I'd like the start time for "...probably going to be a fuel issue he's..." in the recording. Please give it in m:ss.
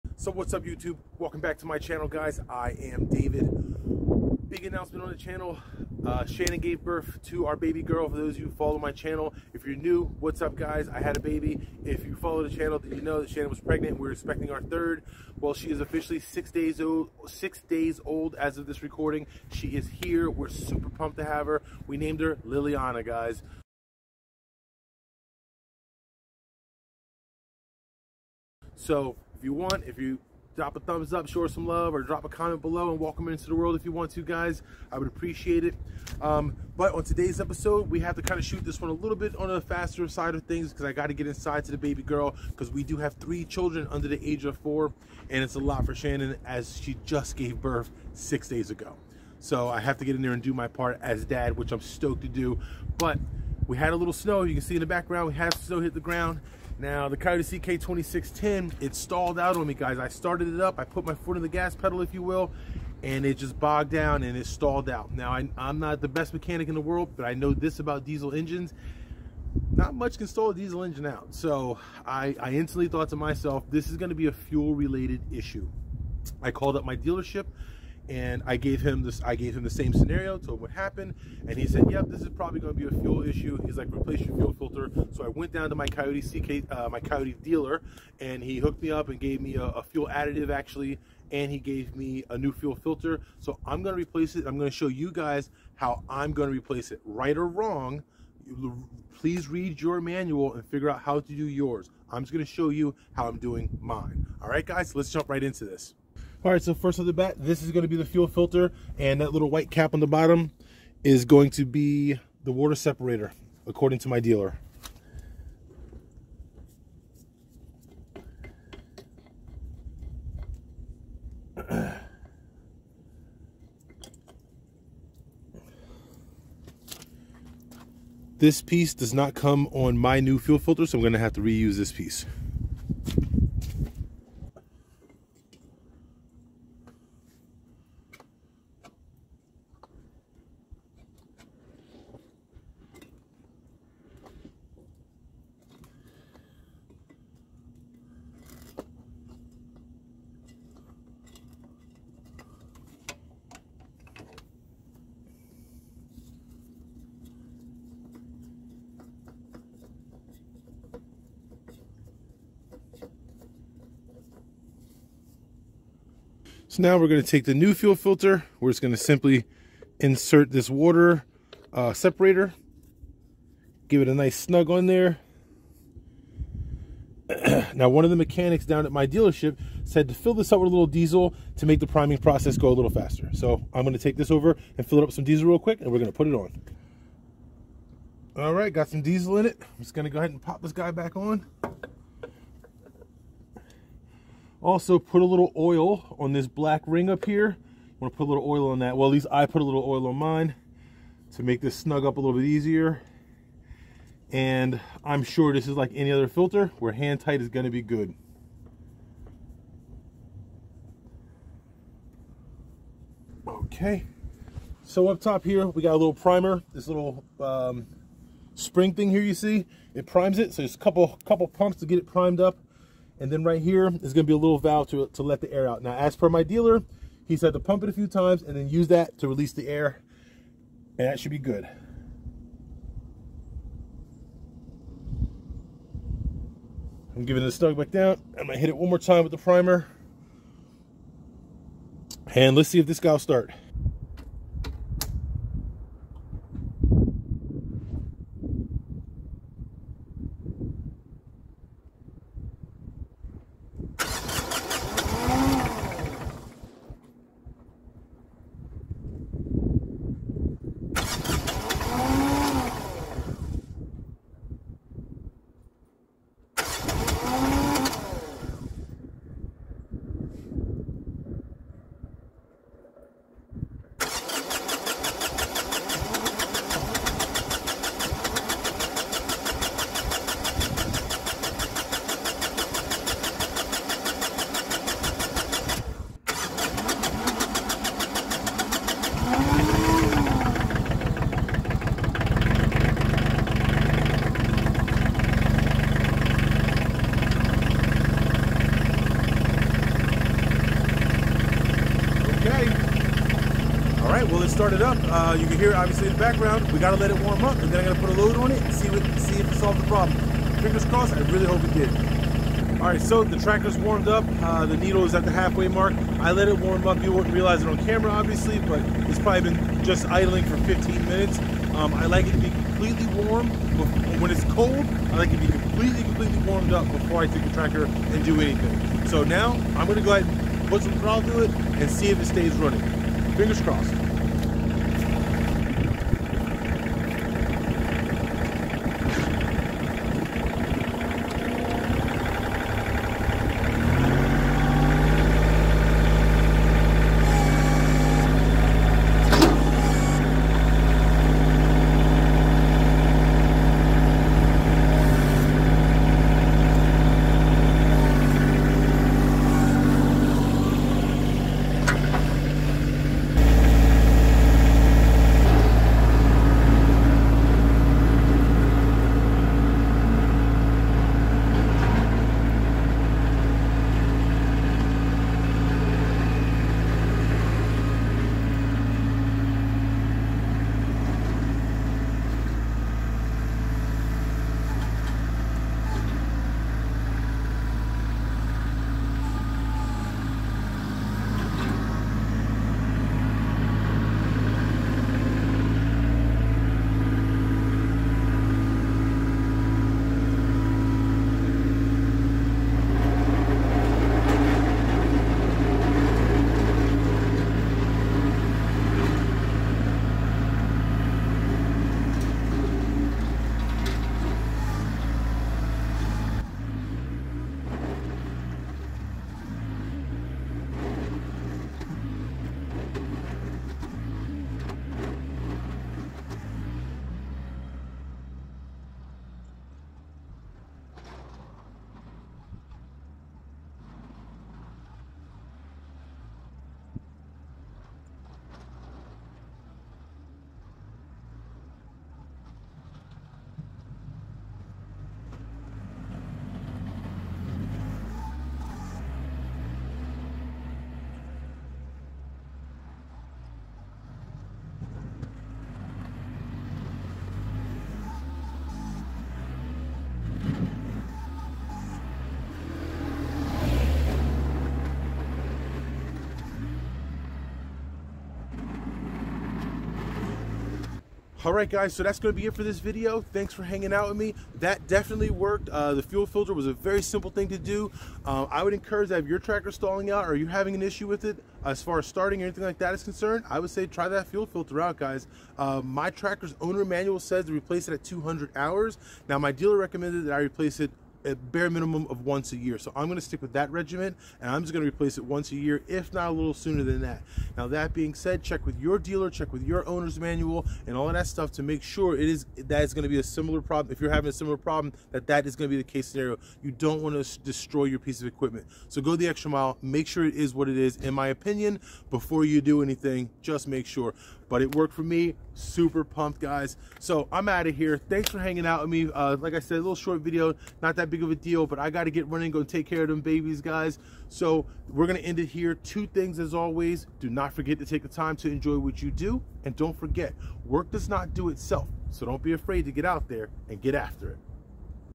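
1:22.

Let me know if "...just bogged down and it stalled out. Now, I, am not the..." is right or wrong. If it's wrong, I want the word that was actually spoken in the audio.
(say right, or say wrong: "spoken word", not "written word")
right.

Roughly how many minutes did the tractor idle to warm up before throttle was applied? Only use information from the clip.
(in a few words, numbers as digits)
15.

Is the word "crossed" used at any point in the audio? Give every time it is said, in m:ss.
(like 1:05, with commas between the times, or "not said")
5:10, 5:33.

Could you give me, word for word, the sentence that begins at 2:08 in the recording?
this piece does not come on my new fuel filter, so I'm gonna have to reuse this piece.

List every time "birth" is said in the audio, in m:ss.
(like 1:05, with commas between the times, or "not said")
0:06, 0:47.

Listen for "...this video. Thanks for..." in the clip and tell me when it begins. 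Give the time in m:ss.
7:52.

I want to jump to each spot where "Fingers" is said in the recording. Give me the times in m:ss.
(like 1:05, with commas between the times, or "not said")
5:10, 5:33.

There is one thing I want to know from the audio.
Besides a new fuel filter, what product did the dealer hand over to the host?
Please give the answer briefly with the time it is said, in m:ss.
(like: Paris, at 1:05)
fuel additive, at 1:29.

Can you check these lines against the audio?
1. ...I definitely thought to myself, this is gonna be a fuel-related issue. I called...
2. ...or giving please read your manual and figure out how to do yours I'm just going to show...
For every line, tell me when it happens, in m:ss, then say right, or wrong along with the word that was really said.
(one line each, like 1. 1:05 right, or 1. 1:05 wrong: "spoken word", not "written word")
1. 1:12 wrong: "instantly", not "definitely"
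2. 1:37 wrong: "wrong", not "giving".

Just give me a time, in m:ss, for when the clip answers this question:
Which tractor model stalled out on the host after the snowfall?
0:57.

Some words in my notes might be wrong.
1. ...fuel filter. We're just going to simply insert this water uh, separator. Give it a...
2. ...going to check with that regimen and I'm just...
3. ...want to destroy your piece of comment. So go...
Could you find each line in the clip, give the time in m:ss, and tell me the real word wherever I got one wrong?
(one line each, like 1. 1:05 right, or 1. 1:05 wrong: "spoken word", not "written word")
1. 2:47 right
2. 8:13 wrong: "stick", not "check"
3. 8:27 wrong: "equipment", not "comment".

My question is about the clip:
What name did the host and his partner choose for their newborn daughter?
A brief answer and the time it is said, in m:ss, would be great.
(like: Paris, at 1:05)
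Liliana, at 0:22.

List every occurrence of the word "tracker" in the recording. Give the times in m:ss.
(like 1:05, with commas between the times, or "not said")
5:13, 5:27, 7:59, 8:06.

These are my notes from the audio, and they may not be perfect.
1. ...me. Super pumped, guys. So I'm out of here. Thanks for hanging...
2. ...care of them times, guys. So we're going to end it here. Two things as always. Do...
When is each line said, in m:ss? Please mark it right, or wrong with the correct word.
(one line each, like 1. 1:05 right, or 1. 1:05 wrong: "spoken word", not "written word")
1. 8:35 right
2. 8:42 wrong: "babies", not "times".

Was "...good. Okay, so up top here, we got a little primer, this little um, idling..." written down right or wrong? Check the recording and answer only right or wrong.
wrong.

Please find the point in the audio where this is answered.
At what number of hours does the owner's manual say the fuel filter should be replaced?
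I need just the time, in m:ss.
8:08.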